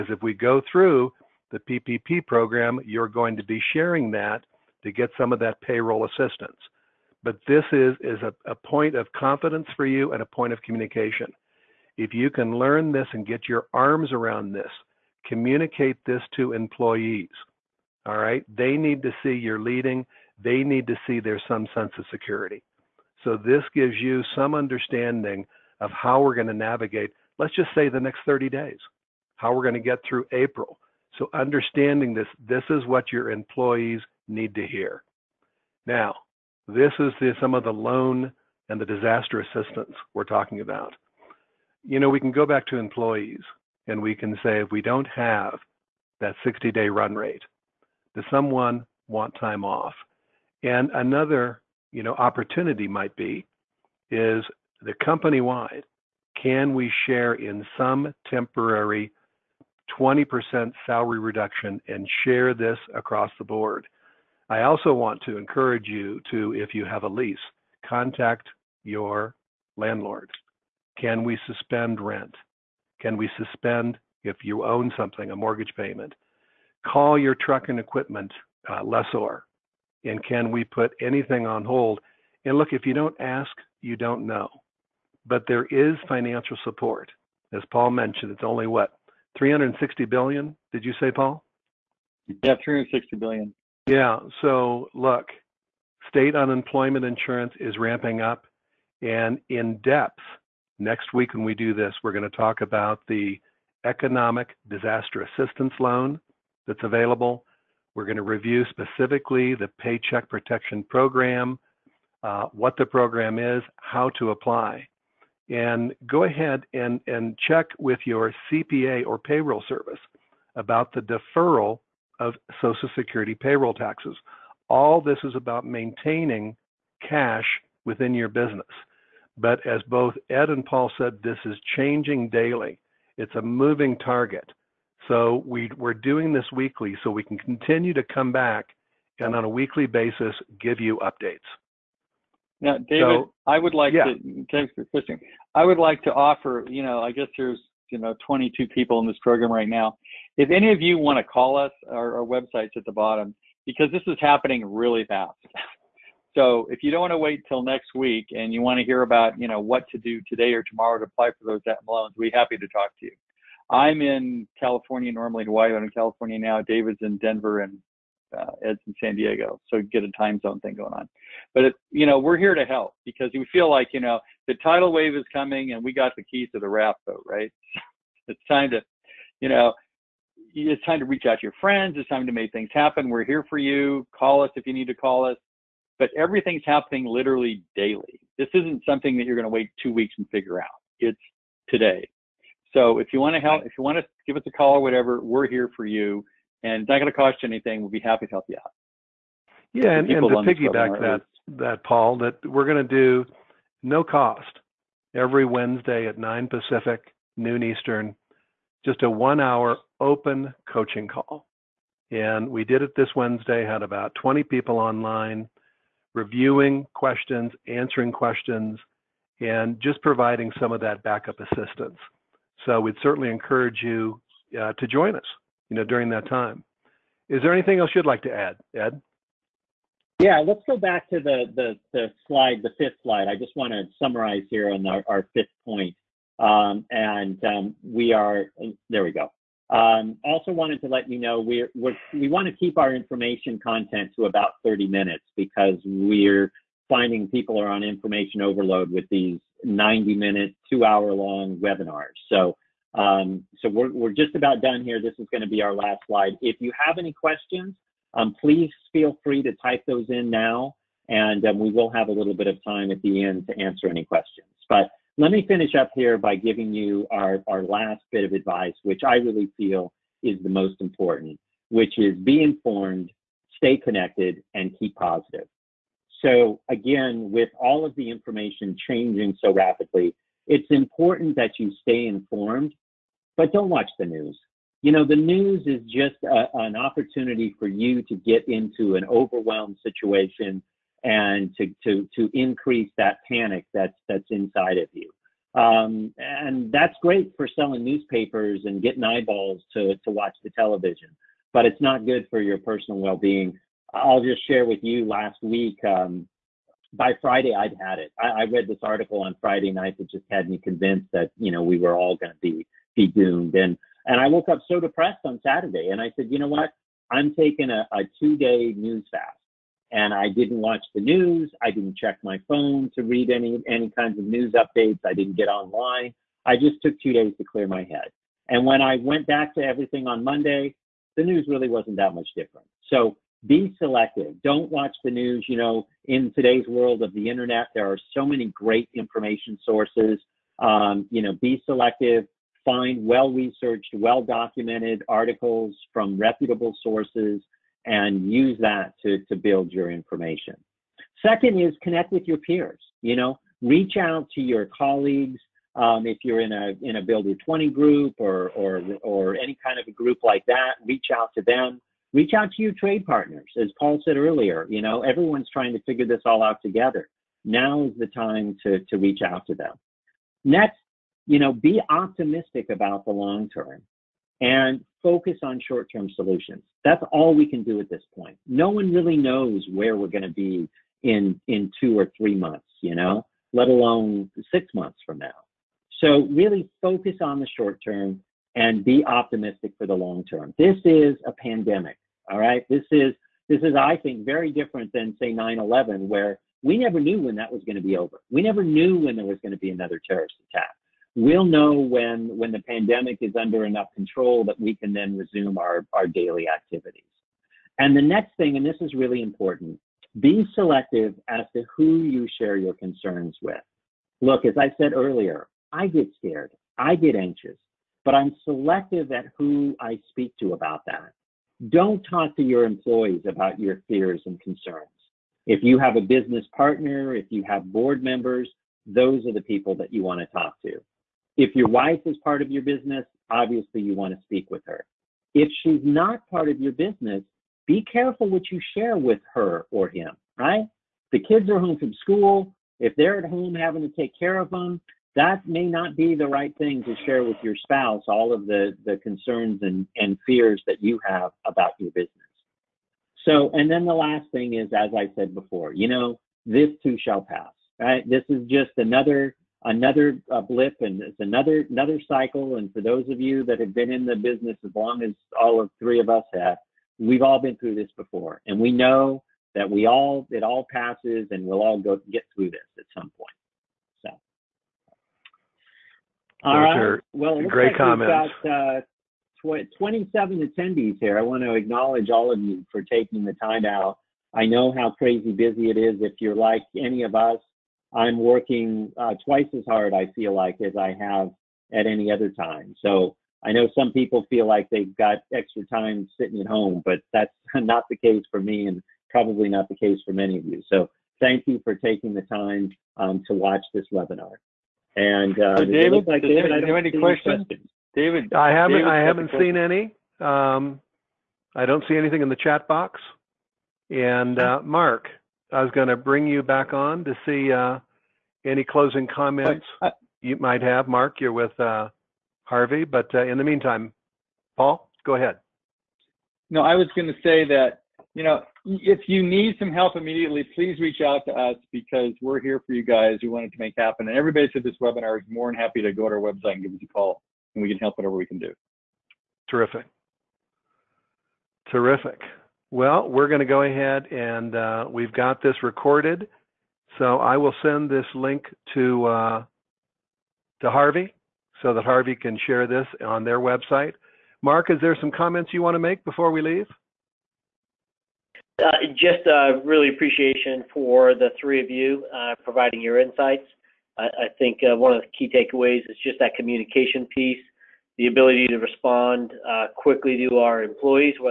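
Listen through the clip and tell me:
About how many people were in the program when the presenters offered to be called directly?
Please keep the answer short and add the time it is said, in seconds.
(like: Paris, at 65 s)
22, at 148 s.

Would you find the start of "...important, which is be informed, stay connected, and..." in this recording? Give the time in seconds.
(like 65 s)
270 s.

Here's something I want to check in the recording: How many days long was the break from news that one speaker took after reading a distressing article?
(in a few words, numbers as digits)
2.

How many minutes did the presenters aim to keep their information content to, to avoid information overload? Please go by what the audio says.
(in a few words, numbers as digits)
30.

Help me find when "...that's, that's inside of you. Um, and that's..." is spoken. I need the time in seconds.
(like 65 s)
293 s.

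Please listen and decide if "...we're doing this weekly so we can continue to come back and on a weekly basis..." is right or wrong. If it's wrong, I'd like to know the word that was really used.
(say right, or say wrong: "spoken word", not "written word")
right.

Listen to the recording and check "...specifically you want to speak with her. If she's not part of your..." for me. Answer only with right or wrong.
wrong.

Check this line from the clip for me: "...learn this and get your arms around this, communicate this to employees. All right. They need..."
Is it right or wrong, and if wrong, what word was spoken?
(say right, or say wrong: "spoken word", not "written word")
right.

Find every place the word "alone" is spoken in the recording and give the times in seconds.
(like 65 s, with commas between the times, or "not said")
383 s.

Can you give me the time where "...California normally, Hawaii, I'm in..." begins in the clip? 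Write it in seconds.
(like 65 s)
164 s.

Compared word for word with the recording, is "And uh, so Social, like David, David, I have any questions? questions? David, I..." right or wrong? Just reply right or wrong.
wrong.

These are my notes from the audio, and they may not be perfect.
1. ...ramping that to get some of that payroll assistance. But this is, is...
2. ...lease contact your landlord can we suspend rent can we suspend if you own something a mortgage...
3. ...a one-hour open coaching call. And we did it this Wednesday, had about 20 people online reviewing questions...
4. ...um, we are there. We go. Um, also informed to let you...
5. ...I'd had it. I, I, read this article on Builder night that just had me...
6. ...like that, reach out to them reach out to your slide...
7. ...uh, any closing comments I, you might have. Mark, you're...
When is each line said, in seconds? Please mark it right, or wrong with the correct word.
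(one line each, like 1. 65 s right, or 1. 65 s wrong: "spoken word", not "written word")
1. 3 s wrong: "sharing", not "ramping"
2. 67 s right
3. 209 s right
4. 237 s wrong: "wanted", not "informed"
5. 307 s wrong: "Friday", not "Builder"
6. 360 s wrong: "trade", not "slide"
7. 517 s right.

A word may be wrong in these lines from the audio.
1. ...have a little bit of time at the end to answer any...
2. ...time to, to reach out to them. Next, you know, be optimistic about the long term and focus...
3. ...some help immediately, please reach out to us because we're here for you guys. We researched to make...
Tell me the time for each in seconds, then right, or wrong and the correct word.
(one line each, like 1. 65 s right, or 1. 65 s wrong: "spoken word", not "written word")
1. 261 s right
2. 368 s right
3. 529 s wrong: "wanted", not "researched".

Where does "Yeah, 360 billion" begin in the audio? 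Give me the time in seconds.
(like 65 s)
92 s.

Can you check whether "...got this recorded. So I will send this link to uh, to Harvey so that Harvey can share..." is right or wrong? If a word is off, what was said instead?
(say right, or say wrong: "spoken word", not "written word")
right.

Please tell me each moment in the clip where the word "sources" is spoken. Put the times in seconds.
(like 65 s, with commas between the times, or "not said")
339 s, 346 s.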